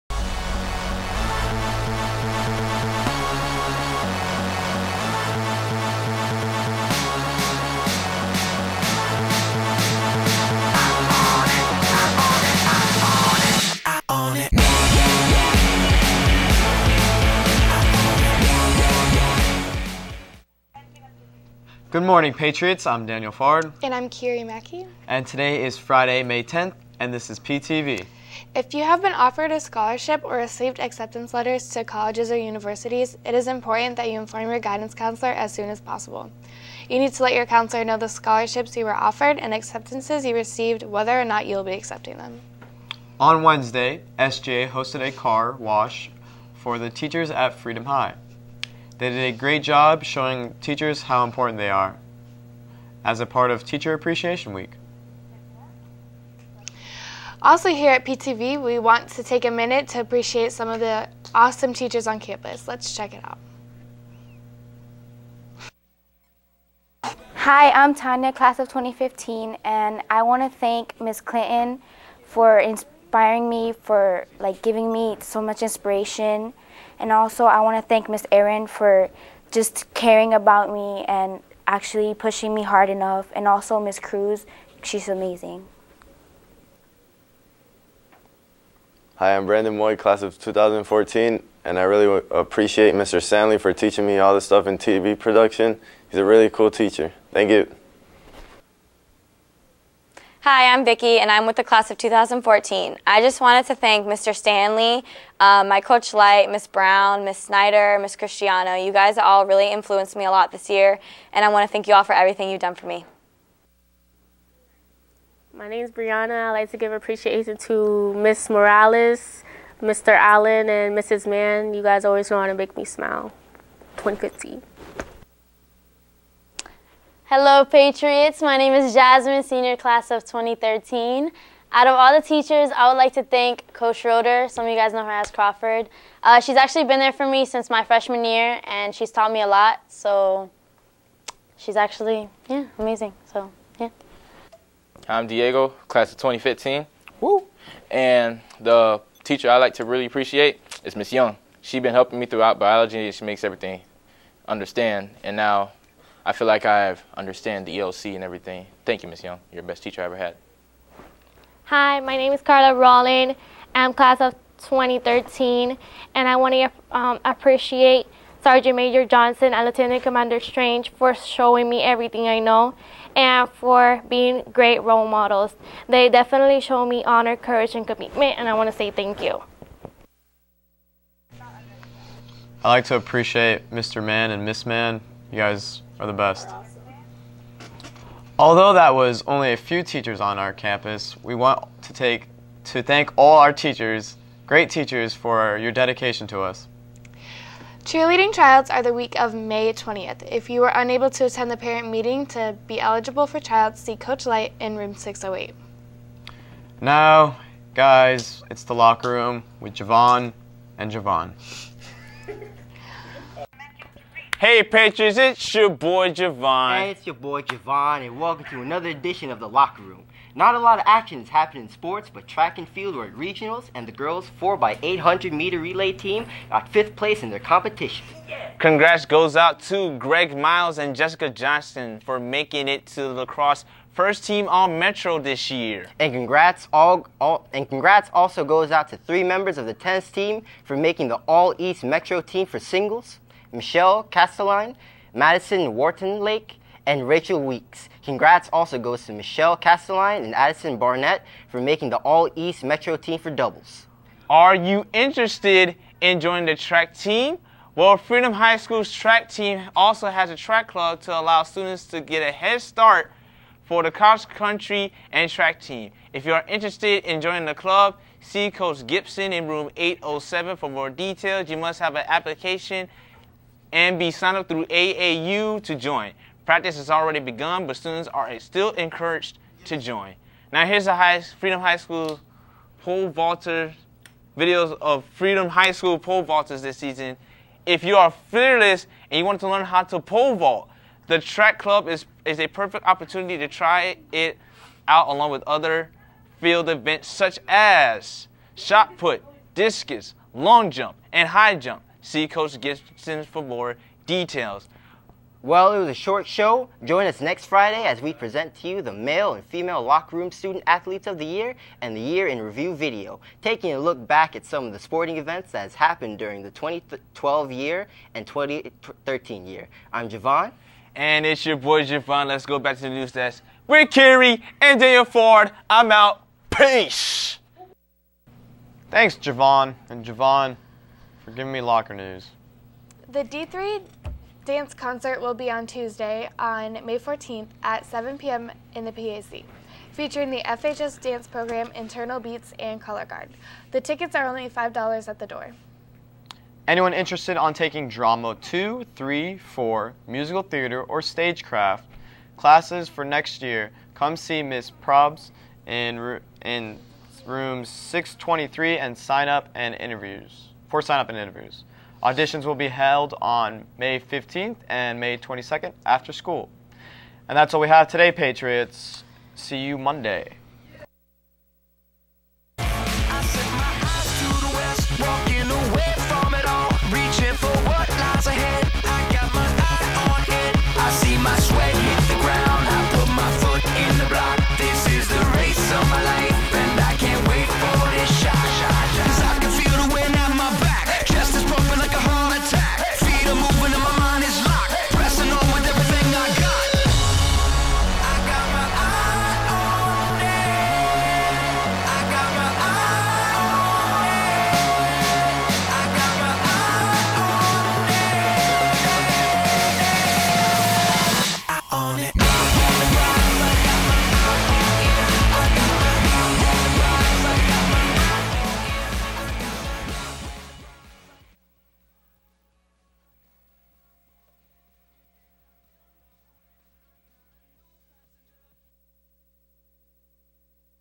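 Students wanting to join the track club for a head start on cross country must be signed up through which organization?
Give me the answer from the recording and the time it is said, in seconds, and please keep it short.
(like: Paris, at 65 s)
AAU, at 274 s.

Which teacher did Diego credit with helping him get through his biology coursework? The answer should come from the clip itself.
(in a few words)
Miss Young.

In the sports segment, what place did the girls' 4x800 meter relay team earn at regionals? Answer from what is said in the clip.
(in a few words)
fifth.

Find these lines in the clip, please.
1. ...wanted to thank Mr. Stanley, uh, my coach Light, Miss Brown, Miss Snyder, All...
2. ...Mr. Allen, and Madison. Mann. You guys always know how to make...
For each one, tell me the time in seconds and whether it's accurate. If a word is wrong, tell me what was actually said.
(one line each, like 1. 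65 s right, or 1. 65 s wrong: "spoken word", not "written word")
1. 103 s wrong: "Miss", not "All"
2. 119 s wrong: "Mrs", not "Madison".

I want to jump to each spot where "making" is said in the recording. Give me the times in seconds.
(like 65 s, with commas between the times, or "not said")
232 s, 240 s, 251 s.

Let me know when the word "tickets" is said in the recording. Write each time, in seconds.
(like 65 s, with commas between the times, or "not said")
343 s.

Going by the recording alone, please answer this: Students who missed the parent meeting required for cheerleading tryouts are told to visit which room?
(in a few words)
608.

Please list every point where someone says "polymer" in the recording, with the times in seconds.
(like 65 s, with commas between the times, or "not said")
not said.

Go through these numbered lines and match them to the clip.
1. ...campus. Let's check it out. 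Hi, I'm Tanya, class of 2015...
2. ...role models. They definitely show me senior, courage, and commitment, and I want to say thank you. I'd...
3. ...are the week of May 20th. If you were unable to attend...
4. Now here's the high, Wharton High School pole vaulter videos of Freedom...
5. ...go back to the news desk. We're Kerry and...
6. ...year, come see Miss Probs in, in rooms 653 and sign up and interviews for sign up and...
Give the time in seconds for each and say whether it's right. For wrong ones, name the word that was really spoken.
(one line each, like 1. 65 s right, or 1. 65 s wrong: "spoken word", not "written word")
1. 62 s right
2. 174 s wrong: "honor", not "senior"
3. 198 s right
4. 280 s wrong: "Freedom", not "Wharton"
5. 322 s right
6. 353 s wrong: "623", not "653".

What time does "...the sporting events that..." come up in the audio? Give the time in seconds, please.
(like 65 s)
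314 s.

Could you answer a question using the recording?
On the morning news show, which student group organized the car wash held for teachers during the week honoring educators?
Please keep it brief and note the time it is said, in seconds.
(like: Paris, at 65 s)
SJA, at 44 s.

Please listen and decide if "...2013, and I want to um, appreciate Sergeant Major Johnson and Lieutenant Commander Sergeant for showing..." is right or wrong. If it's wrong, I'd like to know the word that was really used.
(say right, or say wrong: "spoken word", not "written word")
wrong: "Strange", not "Sergeant".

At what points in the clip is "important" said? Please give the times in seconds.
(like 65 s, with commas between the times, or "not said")
33 s, 51 s.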